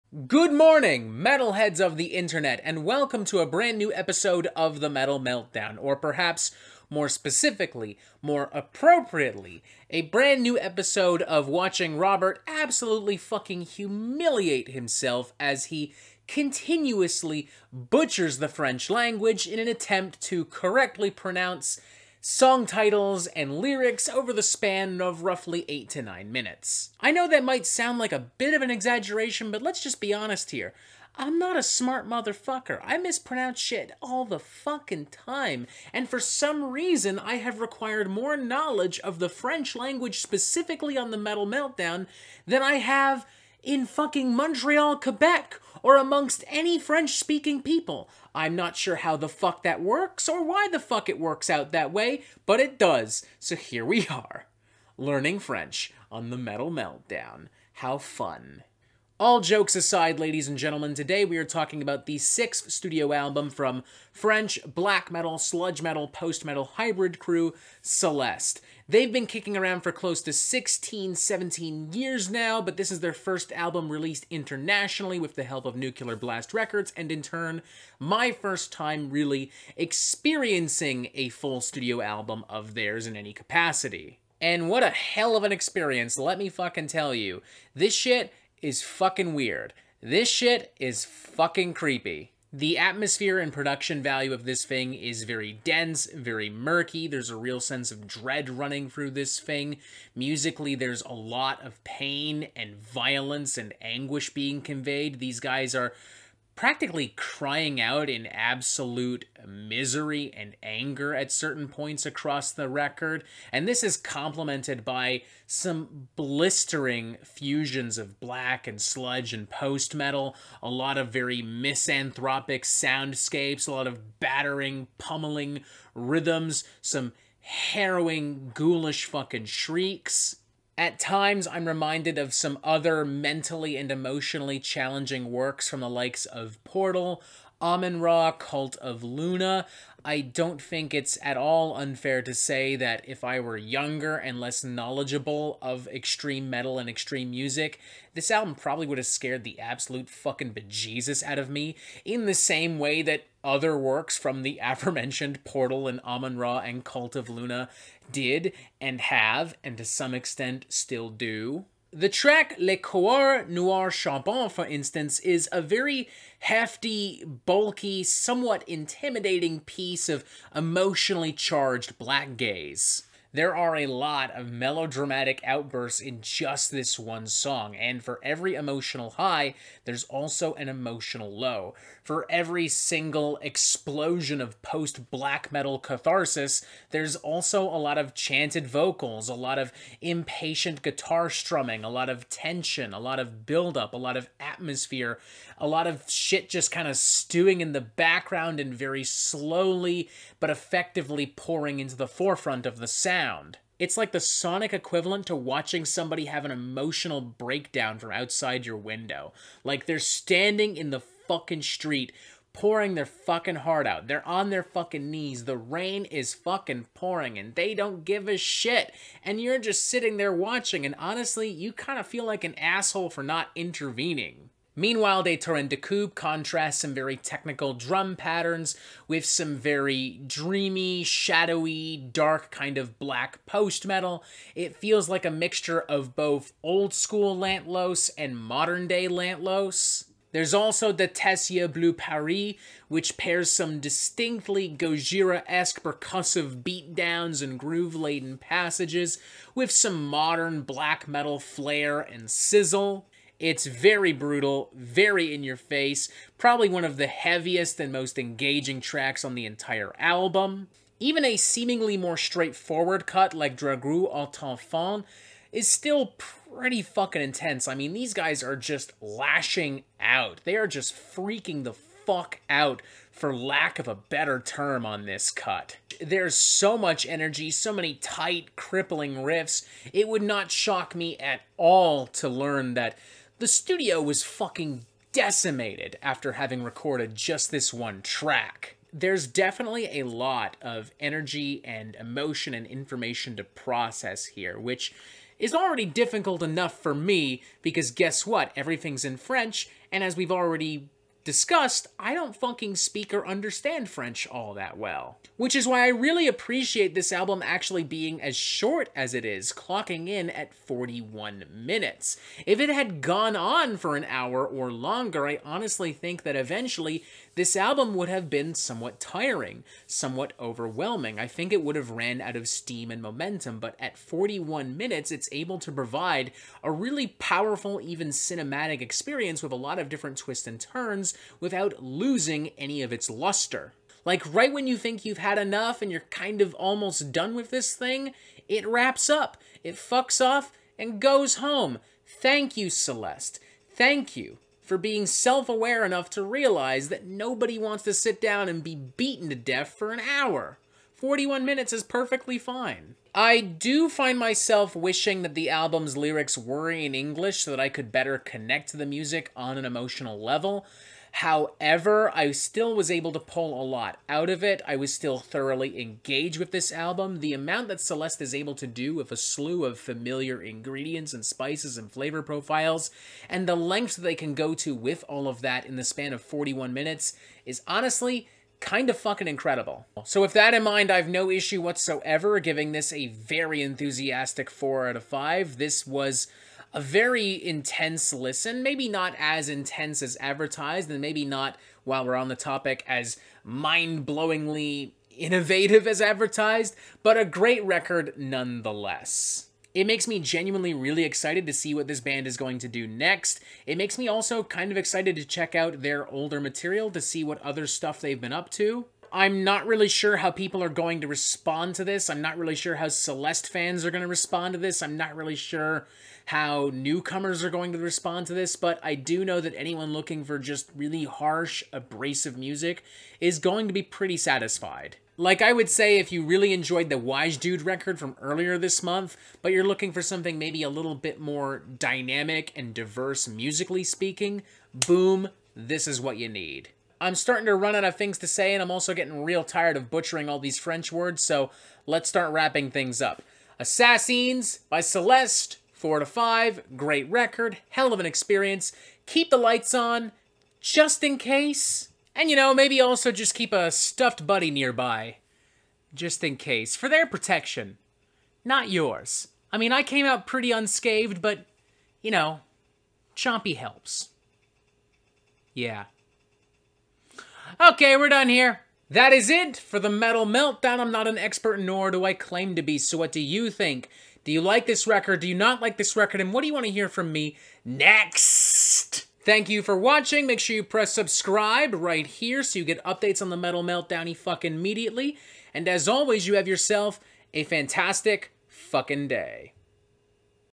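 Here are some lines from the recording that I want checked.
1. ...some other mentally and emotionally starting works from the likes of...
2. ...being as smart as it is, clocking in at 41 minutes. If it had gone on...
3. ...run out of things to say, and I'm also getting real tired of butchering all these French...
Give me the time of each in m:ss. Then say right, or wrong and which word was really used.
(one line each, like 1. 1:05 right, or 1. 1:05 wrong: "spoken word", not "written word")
1. 2:12 wrong: "challenging", not "starting"
2. 5:07 wrong: "short", not "smart"
3. 7:17 right.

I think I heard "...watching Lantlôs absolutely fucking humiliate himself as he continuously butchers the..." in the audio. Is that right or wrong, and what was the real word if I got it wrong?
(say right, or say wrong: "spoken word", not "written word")
wrong: "Robert", not "Lantlôs".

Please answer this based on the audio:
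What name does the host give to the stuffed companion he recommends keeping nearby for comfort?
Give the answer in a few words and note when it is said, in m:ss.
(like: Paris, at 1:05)
Chompy, at 7:43.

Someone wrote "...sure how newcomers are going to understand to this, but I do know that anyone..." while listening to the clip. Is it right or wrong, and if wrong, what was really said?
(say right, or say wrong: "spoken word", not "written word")
wrong: "respond", not "understand".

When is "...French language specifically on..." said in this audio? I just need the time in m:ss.
0:39.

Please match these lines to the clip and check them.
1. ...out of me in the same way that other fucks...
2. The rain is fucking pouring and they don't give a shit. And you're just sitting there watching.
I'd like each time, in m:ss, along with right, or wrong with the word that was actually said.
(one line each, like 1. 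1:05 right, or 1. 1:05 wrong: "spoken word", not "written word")
1. 2:31 wrong: "works", not "fucks"
2. 3:35 right.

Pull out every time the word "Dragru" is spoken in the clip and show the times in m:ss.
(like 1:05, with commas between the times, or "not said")
4:23.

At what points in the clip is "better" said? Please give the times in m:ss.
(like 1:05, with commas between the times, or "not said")
4:33, 5:57.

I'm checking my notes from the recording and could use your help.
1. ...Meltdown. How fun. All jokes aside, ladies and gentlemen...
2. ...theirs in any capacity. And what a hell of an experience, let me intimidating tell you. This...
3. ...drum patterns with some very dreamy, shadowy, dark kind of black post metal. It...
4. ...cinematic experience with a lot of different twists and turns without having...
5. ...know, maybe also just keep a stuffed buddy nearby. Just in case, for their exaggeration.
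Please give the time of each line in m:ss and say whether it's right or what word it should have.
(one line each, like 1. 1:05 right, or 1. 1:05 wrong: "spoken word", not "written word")
1. 0:56 right
2. 1:22 wrong: "fucking", not "intimidating"
3. 3:47 right
4. 5:28 wrong: "losing", not "having"
5. 7:32 wrong: "protection", not "exaggeration".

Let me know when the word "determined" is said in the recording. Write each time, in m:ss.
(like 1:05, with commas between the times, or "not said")
not said.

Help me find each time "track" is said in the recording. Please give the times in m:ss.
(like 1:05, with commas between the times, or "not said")
2:42, 4:18, 4:48.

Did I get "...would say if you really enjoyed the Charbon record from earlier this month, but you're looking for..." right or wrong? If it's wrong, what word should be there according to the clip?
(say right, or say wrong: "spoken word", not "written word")
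wrong: "Wiegedood", not "Charbon".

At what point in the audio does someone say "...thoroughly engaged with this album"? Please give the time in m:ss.
6:05.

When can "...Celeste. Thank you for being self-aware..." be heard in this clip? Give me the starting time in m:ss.
5:42.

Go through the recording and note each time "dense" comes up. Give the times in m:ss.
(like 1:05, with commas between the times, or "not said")
1:35.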